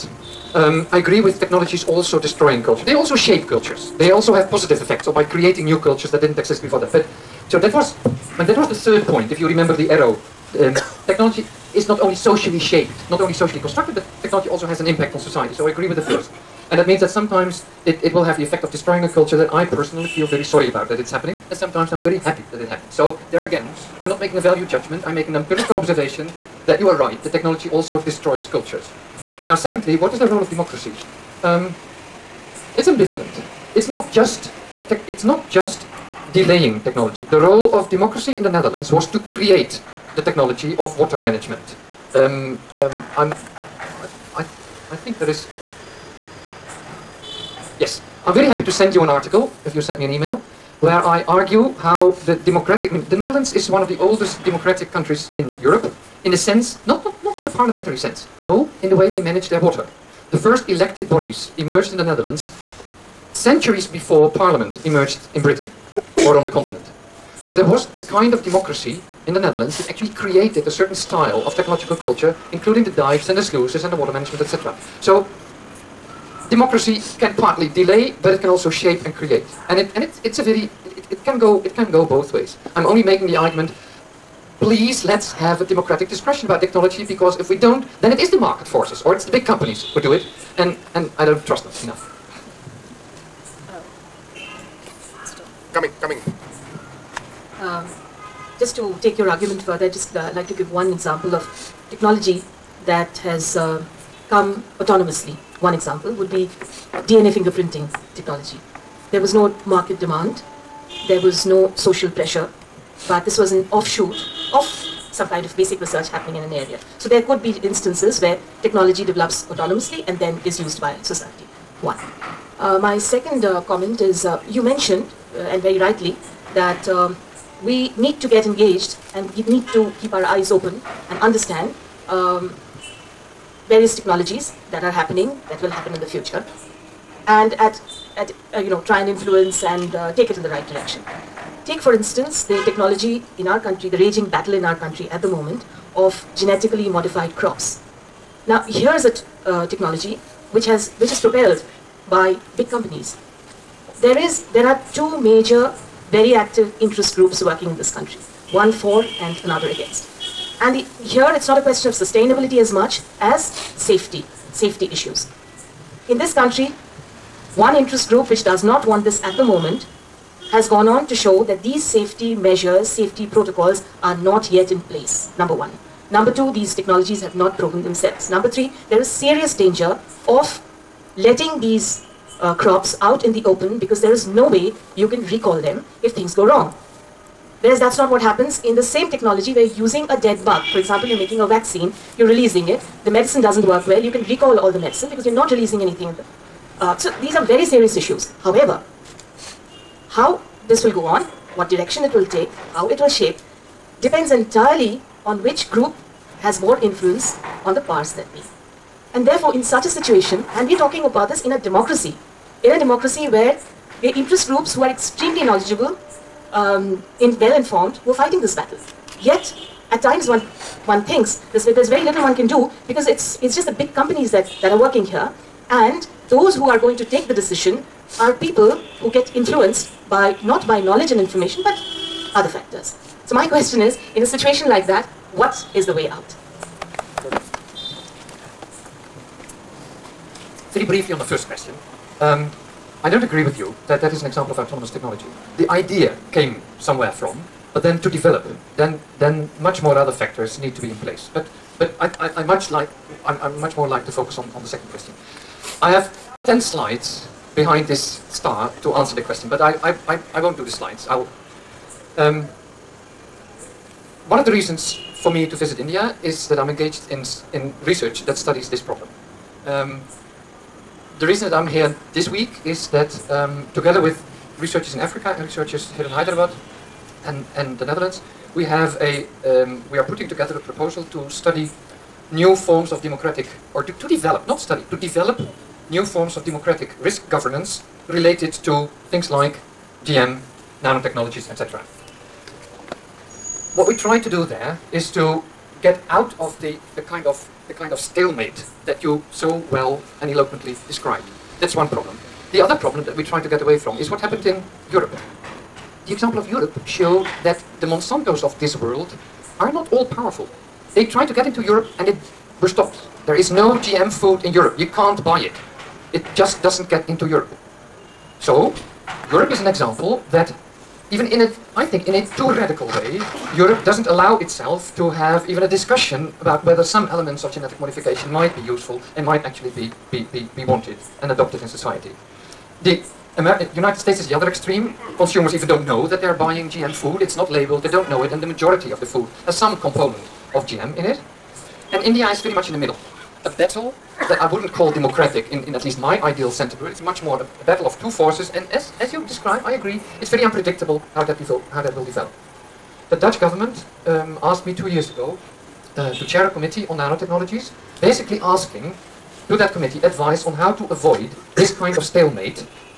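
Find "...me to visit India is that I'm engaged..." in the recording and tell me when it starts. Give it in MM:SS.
04:25.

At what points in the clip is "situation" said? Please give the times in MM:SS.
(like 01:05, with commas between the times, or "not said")
03:29, 03:54.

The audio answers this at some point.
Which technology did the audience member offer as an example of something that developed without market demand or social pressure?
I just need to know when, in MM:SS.
01:47.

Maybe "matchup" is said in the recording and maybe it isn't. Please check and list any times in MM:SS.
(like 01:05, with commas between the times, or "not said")
not said.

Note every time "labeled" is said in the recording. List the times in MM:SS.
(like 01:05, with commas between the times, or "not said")
05:37.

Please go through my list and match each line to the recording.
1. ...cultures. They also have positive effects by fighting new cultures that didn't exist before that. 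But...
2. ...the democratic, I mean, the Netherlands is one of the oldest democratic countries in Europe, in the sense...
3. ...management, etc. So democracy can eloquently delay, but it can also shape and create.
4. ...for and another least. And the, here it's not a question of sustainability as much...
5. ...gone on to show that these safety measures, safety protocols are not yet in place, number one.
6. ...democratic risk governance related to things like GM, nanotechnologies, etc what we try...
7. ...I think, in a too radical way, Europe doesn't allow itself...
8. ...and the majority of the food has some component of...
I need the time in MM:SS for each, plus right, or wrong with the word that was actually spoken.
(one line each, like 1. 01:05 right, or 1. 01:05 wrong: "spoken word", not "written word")
1. 00:03 wrong: "creating", not "fighting"
2. 00:52 right
3. 01:14 wrong: "partly", not "eloquently"
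4. 02:38 wrong: "against", not "least"
5. 02:50 right
6. 04:46 right
7. 05:21 right
8. 05:38 right.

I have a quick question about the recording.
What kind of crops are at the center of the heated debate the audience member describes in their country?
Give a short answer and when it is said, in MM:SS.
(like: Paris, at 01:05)
genetically modified crops, at 02:26.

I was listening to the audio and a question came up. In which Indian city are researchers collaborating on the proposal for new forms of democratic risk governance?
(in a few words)
Hyderabad.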